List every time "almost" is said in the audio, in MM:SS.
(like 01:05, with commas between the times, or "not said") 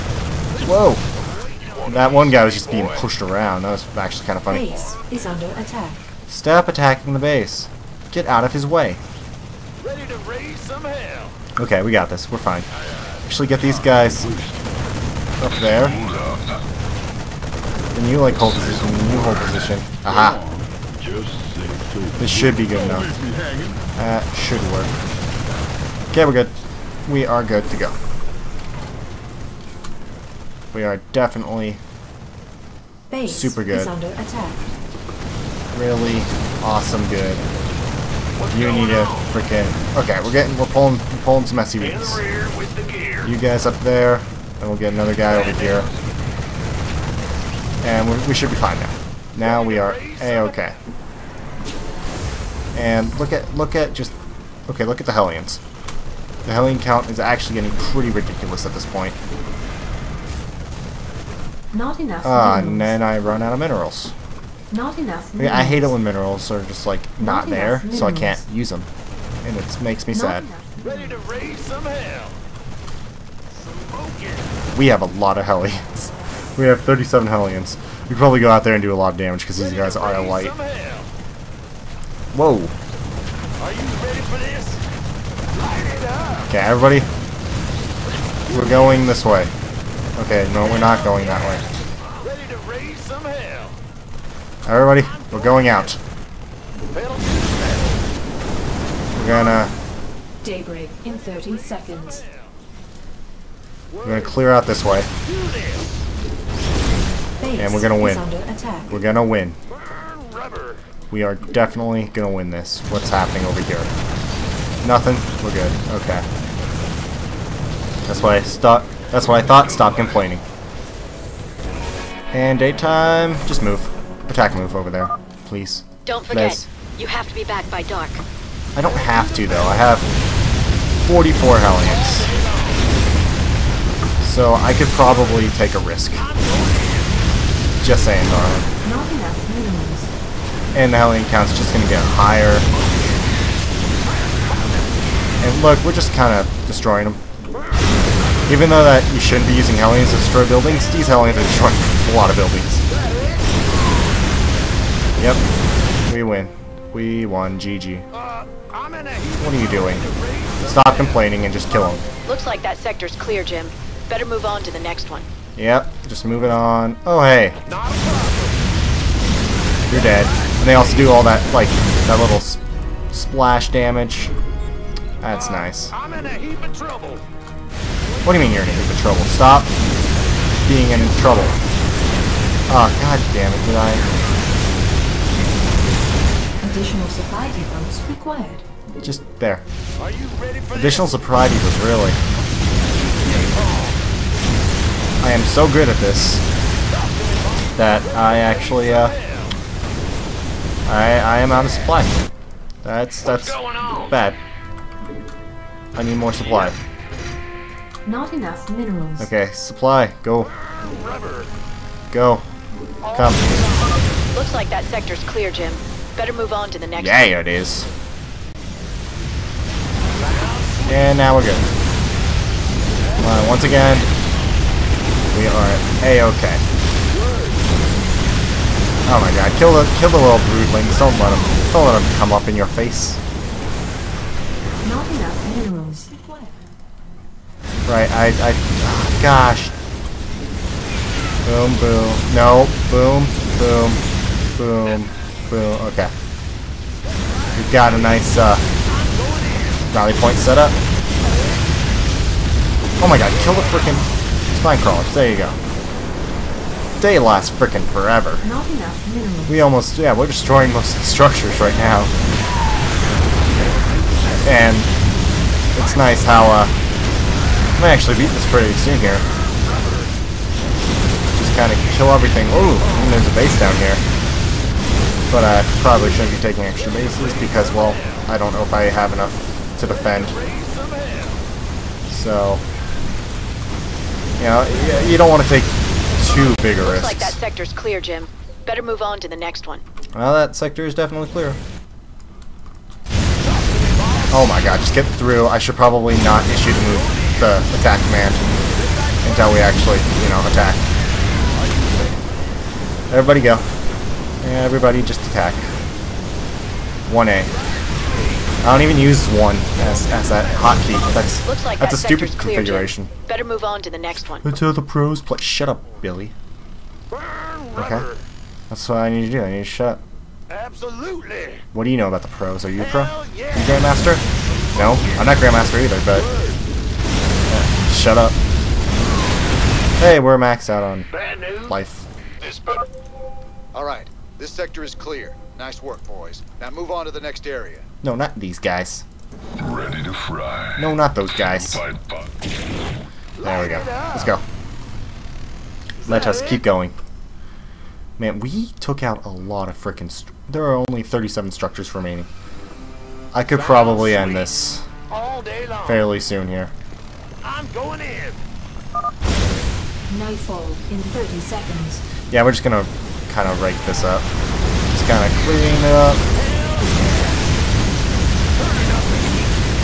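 04:19.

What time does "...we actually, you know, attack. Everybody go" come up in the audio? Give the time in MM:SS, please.
04:59.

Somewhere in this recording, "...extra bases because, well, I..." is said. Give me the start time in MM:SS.
04:36.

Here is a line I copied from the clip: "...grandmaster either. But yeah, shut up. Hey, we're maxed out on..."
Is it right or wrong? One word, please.
right.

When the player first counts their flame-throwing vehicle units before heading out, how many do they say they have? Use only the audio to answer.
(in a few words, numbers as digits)
37.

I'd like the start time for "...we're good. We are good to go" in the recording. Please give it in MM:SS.
00:26.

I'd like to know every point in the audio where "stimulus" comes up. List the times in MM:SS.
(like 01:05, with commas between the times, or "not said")
not said.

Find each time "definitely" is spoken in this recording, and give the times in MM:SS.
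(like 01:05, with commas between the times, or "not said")
00:31, 01:51, 04:50.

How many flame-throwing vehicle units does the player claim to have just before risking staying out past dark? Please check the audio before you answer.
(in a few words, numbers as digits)
44.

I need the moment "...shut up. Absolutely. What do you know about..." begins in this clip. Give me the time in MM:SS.
05:19.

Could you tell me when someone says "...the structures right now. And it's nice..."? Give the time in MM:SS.
04:21.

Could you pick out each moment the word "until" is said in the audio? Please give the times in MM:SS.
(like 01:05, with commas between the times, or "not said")
04:59, 05:14.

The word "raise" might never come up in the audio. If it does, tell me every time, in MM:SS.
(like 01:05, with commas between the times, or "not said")
00:10, 01:11, 01:32.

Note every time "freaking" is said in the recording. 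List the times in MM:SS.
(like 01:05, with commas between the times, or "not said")
00:39, 04:13, 05:49.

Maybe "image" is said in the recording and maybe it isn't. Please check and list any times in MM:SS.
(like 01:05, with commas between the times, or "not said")
not said.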